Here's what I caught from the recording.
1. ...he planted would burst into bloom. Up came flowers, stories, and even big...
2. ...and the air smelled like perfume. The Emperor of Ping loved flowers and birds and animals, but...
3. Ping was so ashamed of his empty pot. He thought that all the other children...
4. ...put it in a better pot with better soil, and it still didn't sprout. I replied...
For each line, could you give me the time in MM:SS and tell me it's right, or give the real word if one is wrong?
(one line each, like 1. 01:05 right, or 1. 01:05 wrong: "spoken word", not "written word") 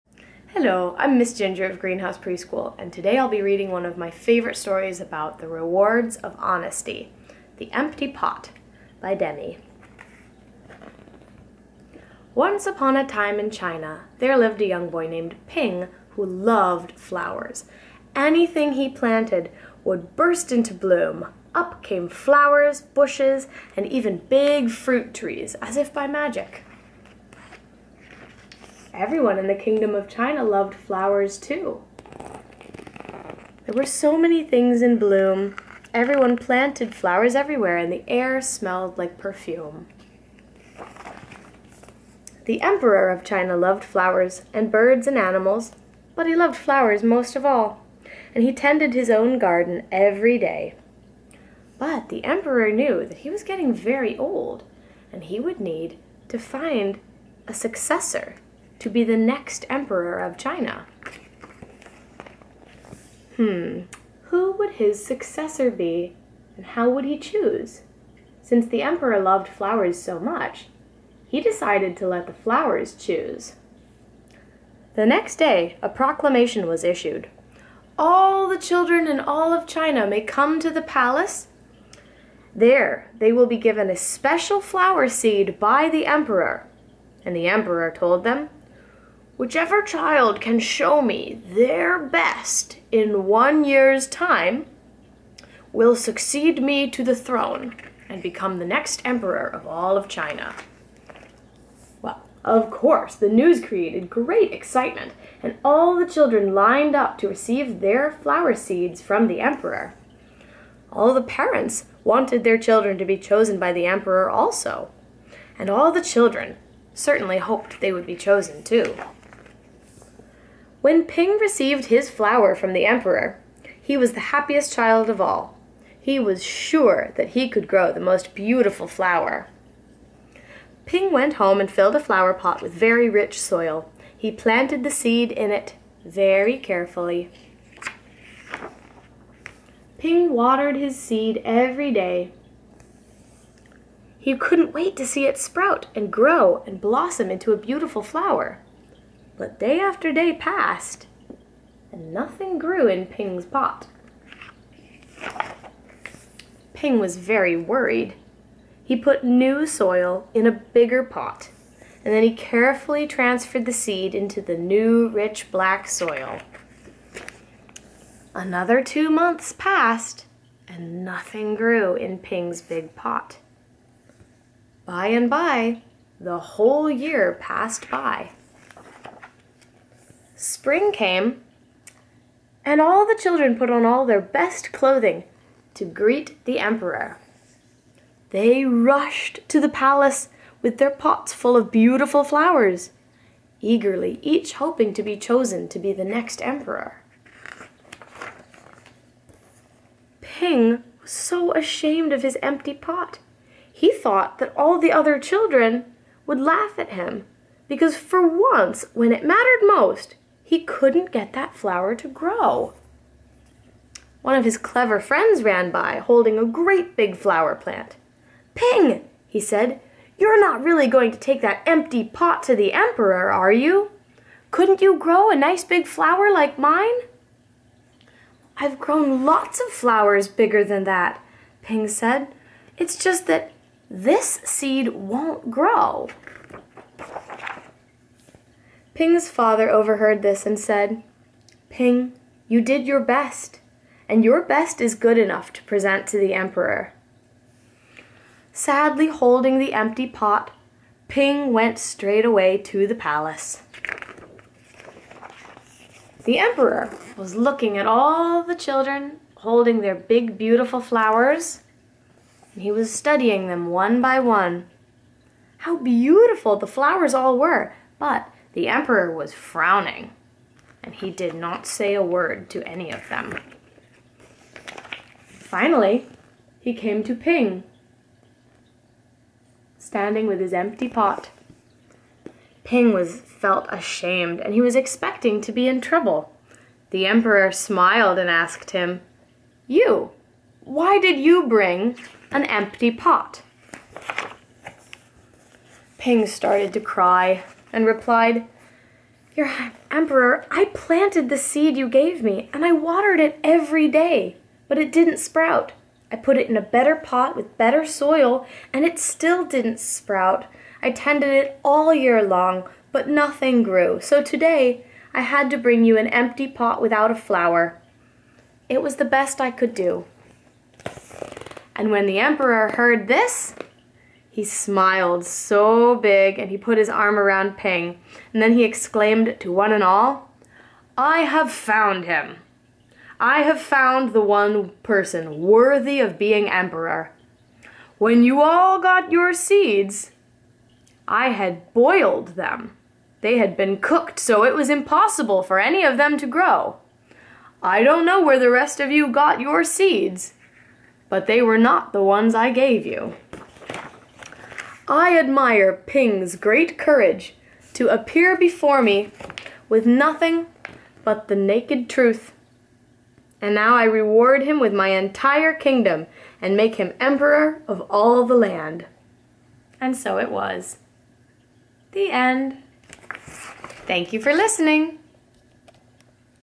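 1. 00:18 wrong: "bushes", not "stories"
2. 00:37 wrong: "China", not "Ping"
3. 03:20 right
4. 05:06 wrong: "tended", not "replied".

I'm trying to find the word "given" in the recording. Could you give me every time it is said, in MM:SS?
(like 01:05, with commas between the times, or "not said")
01:23.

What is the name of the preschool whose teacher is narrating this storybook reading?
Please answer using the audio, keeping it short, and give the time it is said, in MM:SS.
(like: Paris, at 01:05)
Greenhouse Preschool, at 00:01.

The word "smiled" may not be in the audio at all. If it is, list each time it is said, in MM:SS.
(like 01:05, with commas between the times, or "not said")
04:47, 05:24.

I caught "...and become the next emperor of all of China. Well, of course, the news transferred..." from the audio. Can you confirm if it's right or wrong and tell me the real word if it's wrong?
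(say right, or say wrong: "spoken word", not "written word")
wrong: "created", not "transferred".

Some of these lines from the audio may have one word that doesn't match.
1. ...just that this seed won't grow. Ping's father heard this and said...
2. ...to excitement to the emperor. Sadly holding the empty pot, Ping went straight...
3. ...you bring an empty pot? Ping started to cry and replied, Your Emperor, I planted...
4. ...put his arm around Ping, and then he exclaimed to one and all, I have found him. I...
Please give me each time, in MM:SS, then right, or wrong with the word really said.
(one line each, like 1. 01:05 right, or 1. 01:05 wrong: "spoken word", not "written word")
1. 03:53 wrong: "overheard", not "heard"
2. 04:05 wrong: "present", not "excitement"
3. 04:51 right
4. 05:26 right.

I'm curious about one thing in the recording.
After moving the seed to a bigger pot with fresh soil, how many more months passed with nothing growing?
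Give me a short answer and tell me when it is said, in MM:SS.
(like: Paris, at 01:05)
2, at 02:48.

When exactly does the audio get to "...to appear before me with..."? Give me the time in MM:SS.
05:57.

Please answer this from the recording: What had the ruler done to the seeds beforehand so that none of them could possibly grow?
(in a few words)
Boiled them.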